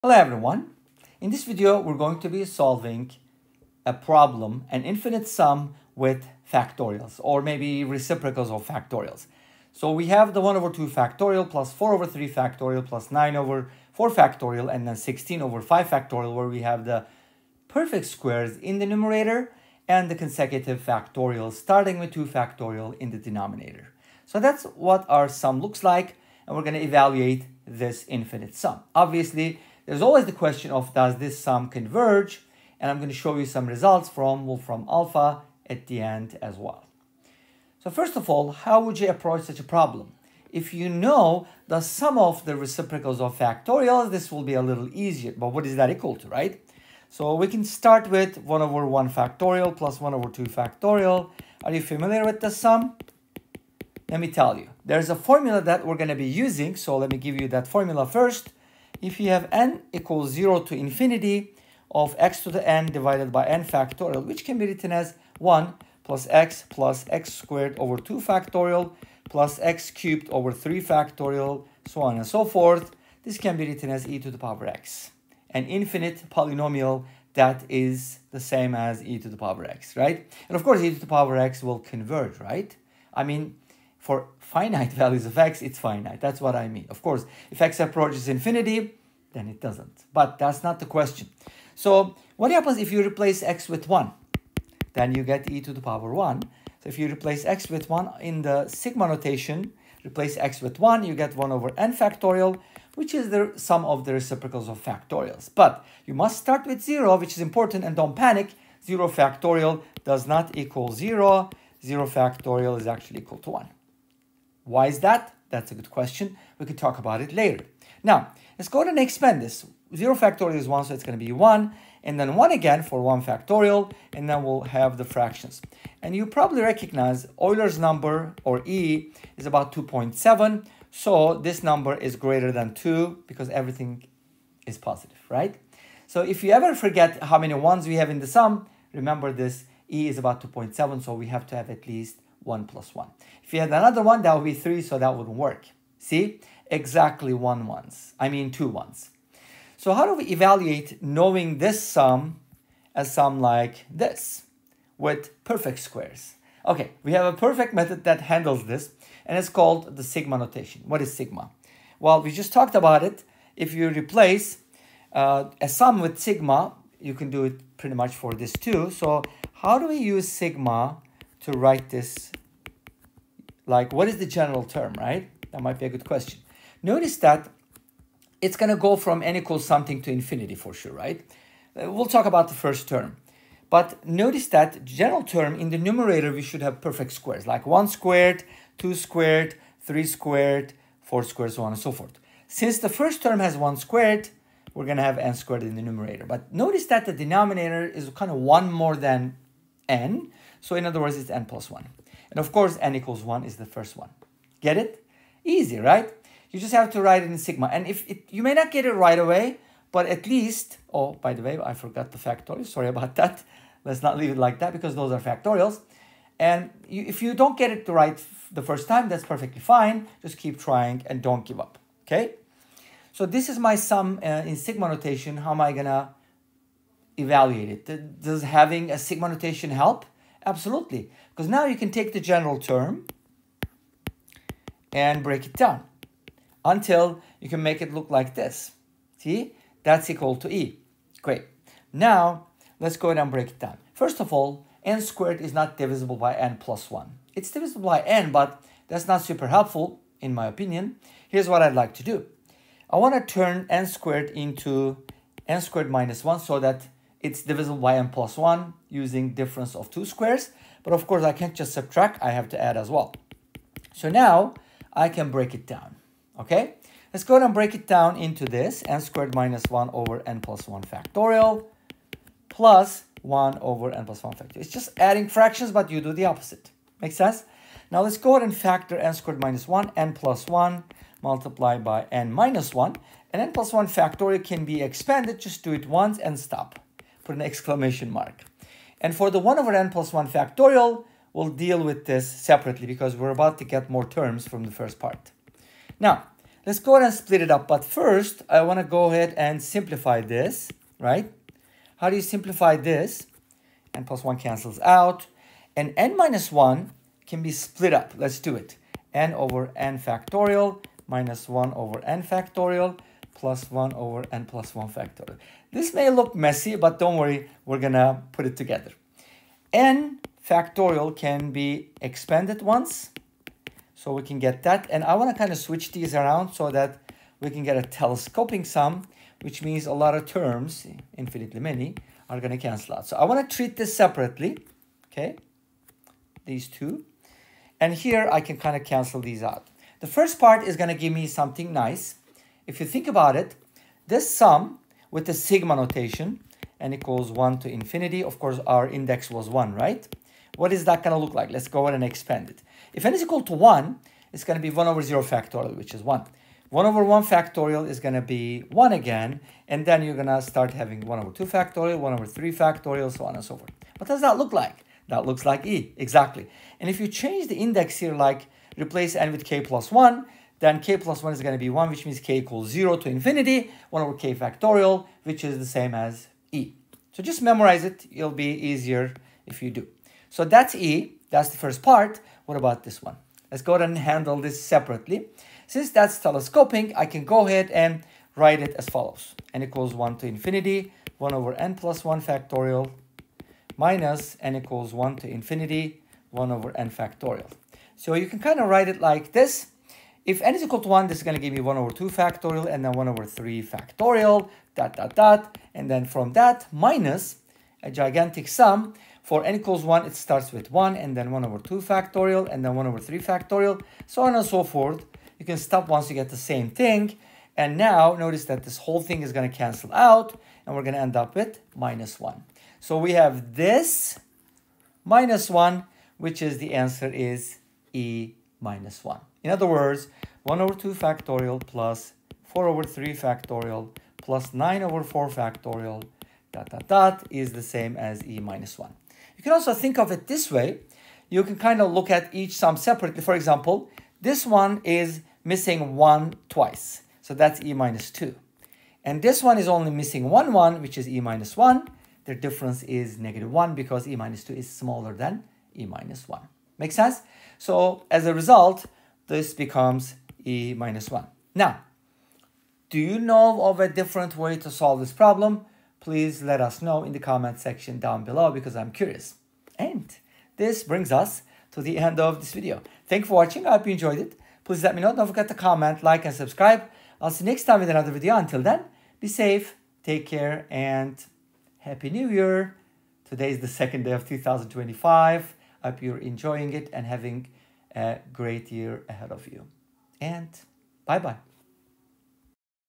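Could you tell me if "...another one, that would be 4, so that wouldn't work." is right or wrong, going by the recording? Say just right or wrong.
wrong.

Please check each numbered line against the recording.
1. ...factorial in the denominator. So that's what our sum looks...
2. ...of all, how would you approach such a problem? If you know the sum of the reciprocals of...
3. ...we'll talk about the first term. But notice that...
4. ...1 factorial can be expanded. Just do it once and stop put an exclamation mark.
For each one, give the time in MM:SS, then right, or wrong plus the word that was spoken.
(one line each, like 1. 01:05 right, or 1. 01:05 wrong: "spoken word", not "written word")
1. 00:22 right
2. 00:38 right
3. 03:01 right
4. 04:43 right.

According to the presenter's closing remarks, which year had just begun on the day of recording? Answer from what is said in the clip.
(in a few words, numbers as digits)
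2025.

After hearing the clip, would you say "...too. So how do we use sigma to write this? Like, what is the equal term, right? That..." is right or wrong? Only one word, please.
wrong.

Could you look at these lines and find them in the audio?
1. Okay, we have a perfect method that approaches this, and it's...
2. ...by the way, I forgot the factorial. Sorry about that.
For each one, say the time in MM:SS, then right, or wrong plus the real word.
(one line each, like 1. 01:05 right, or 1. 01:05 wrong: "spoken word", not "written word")
1. 02:36 wrong: "handles", not "approaches"
2. 03:31 right.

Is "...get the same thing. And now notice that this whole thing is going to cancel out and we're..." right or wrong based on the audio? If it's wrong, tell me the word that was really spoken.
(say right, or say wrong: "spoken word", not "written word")
right.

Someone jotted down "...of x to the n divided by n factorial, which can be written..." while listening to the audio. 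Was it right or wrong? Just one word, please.
right.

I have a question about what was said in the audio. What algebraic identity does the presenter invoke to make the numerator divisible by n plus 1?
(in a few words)
Difference of two squares.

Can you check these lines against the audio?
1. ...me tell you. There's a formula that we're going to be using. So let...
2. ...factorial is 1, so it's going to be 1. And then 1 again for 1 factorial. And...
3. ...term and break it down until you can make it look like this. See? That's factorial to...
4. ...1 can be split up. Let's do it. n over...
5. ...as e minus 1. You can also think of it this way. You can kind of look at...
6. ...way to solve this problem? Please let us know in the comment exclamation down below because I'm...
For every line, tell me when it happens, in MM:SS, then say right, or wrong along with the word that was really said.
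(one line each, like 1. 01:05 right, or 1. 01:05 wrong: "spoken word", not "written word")
1. 00:54 right
2. 02:00 right
3. 03:52 wrong: "equal", not "factorial"
4. 05:06 right
5. 07:17 right
6. 07:44 wrong: "section", not "exclamation".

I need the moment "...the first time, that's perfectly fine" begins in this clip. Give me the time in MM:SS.
03:38.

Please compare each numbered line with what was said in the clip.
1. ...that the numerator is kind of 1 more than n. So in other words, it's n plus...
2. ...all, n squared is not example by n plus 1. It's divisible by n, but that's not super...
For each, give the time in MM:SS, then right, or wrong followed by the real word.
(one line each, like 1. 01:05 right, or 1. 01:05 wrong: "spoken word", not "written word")
1. 03:16 wrong: "denominator", not "numerator"
2. 04:04 wrong: "divisible", not "example".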